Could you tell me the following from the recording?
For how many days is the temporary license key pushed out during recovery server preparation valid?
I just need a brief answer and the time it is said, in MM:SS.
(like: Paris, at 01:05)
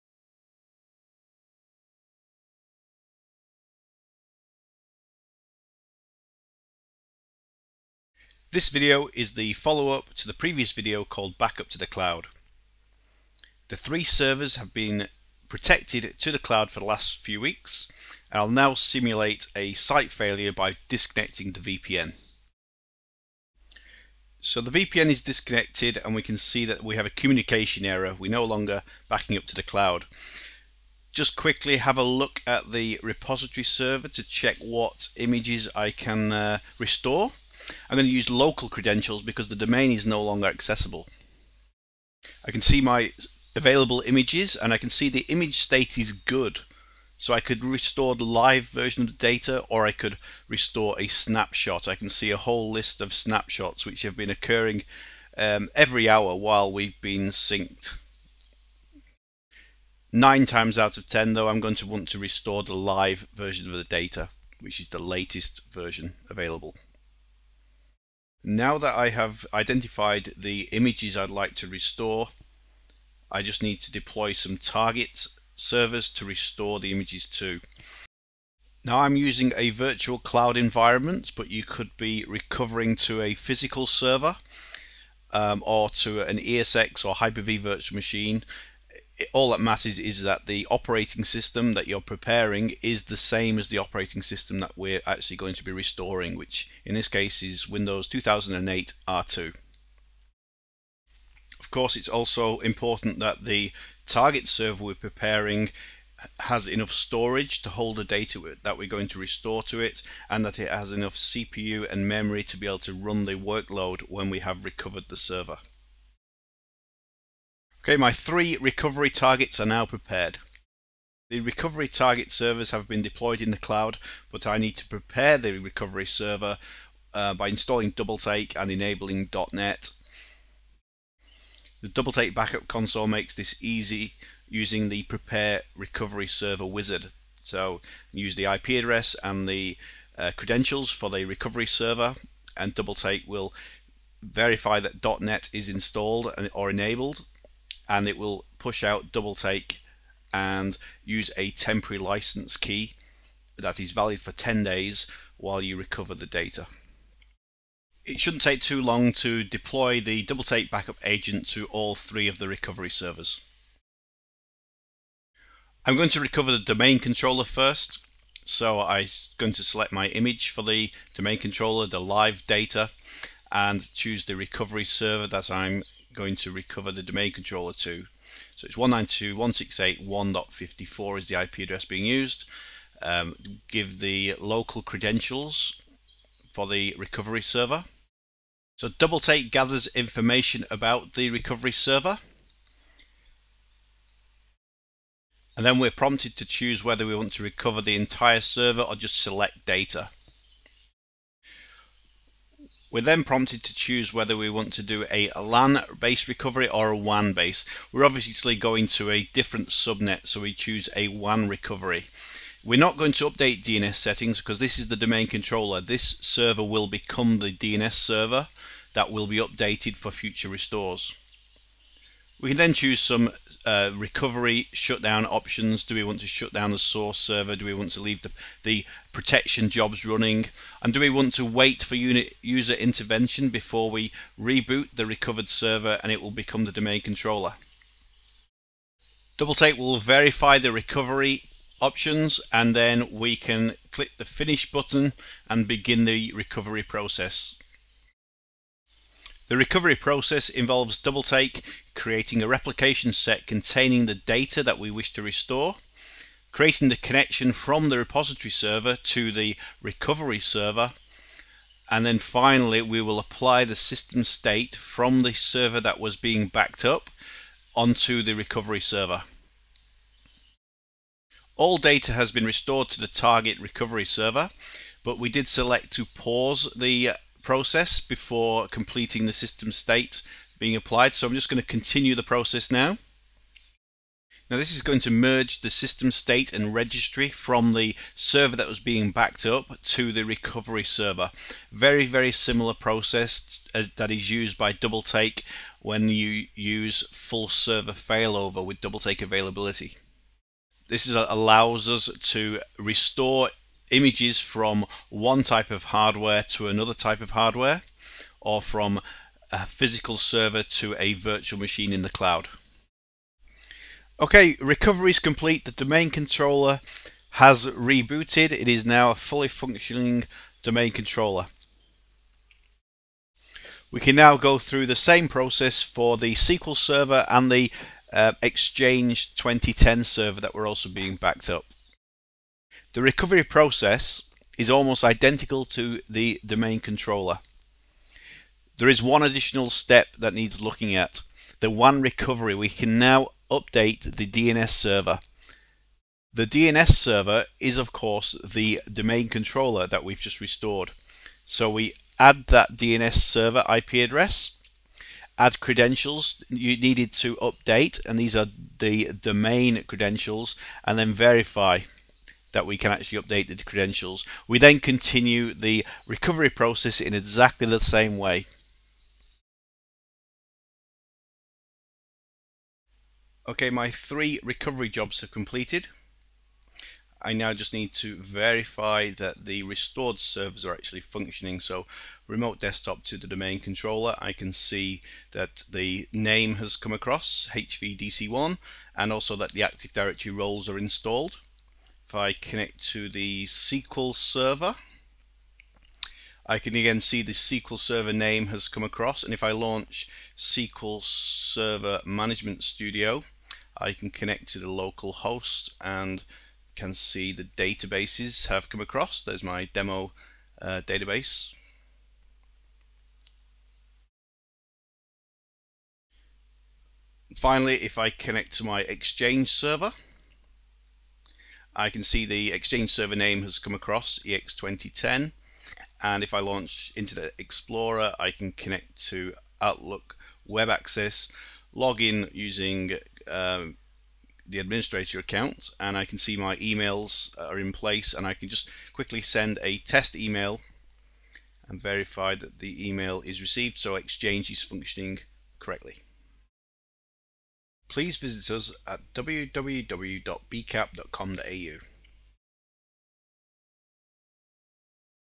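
10, at 02:34.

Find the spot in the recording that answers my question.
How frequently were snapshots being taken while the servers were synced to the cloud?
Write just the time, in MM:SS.
00:55.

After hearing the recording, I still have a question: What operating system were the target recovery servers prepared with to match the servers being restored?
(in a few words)
Windows 2008 R2.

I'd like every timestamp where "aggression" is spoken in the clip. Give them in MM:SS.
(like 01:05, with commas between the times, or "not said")
not said.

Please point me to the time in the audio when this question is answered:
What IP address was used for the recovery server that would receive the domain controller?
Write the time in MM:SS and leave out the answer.
02:58.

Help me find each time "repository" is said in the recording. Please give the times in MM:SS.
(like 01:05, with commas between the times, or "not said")
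00:33, 04:17.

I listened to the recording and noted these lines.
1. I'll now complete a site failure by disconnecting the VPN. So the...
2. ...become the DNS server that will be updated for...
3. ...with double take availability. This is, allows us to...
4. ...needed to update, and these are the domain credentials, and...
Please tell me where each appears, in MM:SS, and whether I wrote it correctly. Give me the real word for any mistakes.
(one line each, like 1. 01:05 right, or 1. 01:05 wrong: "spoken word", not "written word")
1. 00:18 wrong: "simulate", not "complete"
2. 03:36 right
3. 04:58 right
4. 05:56 right.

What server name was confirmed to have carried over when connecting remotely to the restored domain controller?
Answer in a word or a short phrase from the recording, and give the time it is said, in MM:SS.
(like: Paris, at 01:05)
HVDC1, at 06:27.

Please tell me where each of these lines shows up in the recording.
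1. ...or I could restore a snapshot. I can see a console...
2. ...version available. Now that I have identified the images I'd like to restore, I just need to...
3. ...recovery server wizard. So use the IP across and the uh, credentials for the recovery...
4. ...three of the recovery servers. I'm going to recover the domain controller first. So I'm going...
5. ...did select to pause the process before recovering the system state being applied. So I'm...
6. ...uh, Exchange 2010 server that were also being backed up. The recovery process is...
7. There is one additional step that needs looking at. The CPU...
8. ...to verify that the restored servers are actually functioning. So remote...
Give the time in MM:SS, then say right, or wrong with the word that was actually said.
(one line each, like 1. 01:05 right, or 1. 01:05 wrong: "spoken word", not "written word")
1. 00:49 wrong: "whole", not "console"
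2. 01:05 right
3. 02:15 wrong: "address", not "across"
4. 02:41 right
5. 04:35 wrong: "completing", not "recovering"
6. 05:28 right
7. 05:38 wrong: "WAN", not "CPU"
8. 06:17 right.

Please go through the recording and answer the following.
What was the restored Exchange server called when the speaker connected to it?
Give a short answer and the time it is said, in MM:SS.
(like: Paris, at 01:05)
EX2010, at 07:04.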